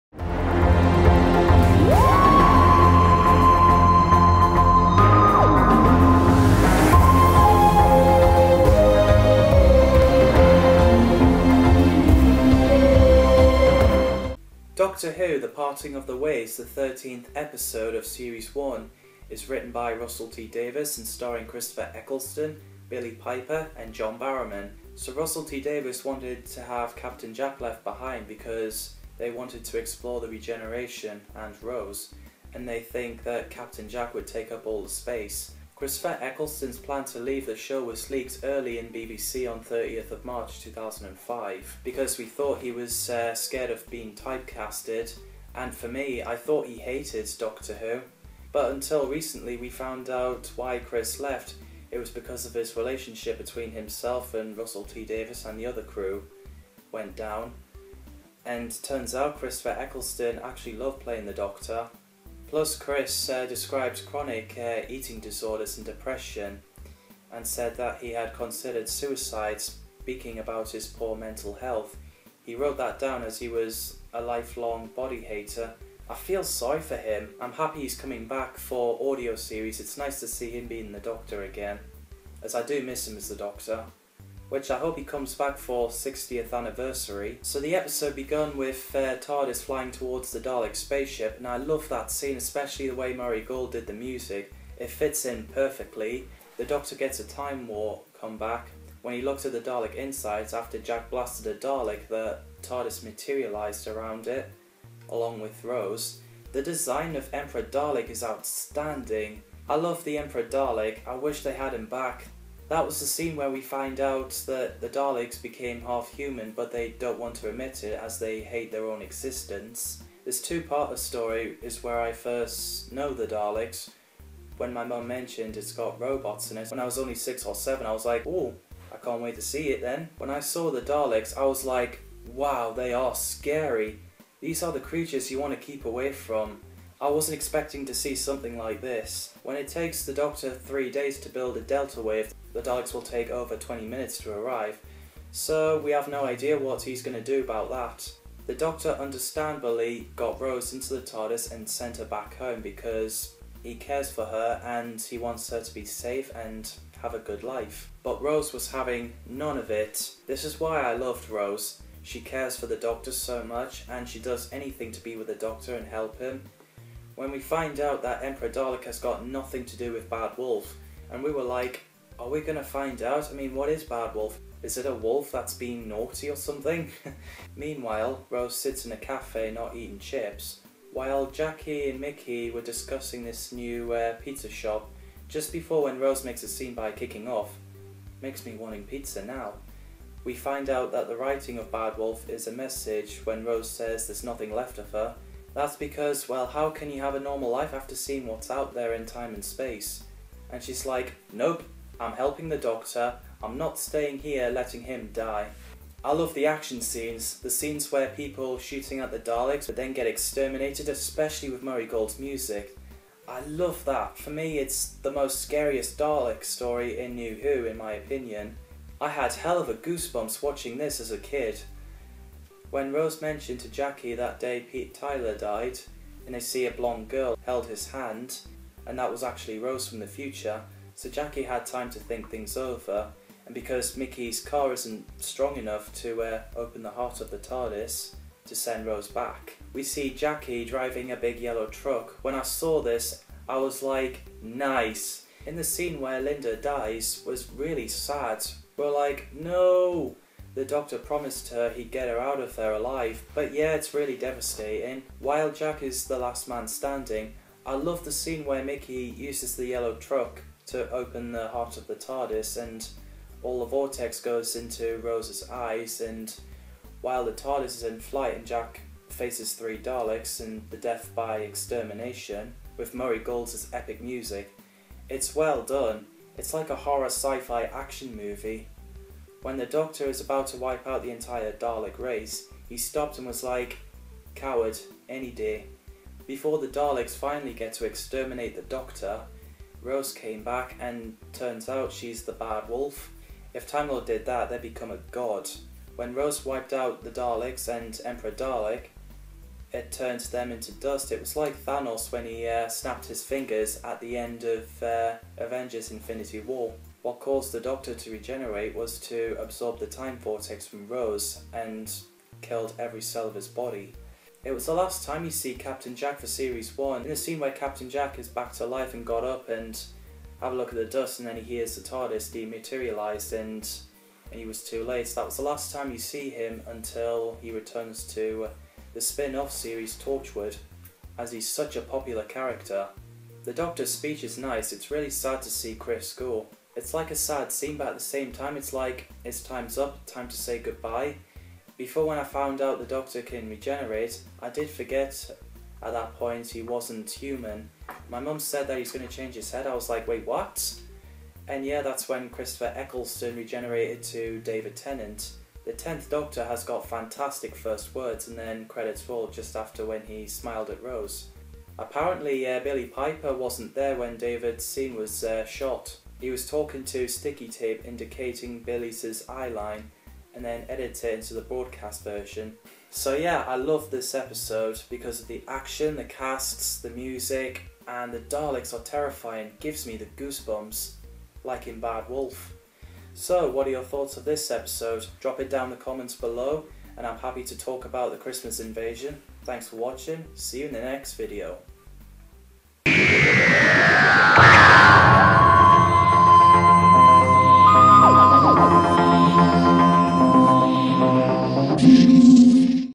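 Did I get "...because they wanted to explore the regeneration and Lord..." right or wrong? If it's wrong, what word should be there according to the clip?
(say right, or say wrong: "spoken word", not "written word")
wrong: "Rose", not "Lord".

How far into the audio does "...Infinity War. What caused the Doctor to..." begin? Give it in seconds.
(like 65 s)
305 s.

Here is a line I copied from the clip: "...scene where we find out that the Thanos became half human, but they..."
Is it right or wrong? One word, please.
wrong.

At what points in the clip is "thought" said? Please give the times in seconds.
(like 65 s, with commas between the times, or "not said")
42 s, 46 s, 383 s.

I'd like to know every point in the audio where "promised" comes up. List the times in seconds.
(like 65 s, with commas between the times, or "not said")
250 s.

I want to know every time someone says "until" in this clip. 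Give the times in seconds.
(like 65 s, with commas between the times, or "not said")
48 s, 326 s.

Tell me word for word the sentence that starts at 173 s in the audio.
I mean, what is Bad Wolf?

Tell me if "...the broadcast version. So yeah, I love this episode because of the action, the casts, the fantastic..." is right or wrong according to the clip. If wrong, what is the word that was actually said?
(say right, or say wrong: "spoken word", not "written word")
wrong: "music", not "fantastic".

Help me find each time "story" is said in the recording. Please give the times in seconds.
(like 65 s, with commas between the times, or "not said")
120 s, 216 s.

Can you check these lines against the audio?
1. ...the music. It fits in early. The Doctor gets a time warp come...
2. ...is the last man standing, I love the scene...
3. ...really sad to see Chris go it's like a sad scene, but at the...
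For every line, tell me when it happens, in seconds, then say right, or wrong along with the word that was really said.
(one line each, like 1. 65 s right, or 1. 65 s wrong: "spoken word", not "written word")
1. 93 s wrong: "perfectly", not "early"
2. 255 s right
3. 334 s right.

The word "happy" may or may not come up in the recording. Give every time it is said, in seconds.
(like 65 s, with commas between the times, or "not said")
77 s, 387 s.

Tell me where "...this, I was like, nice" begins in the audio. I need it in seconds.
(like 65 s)
242 s.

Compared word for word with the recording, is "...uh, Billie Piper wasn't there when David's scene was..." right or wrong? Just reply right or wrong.
right.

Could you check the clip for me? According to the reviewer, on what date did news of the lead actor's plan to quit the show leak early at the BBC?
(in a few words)
30 March 2005.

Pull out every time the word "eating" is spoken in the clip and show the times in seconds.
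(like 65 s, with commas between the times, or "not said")
64 s, 179 s.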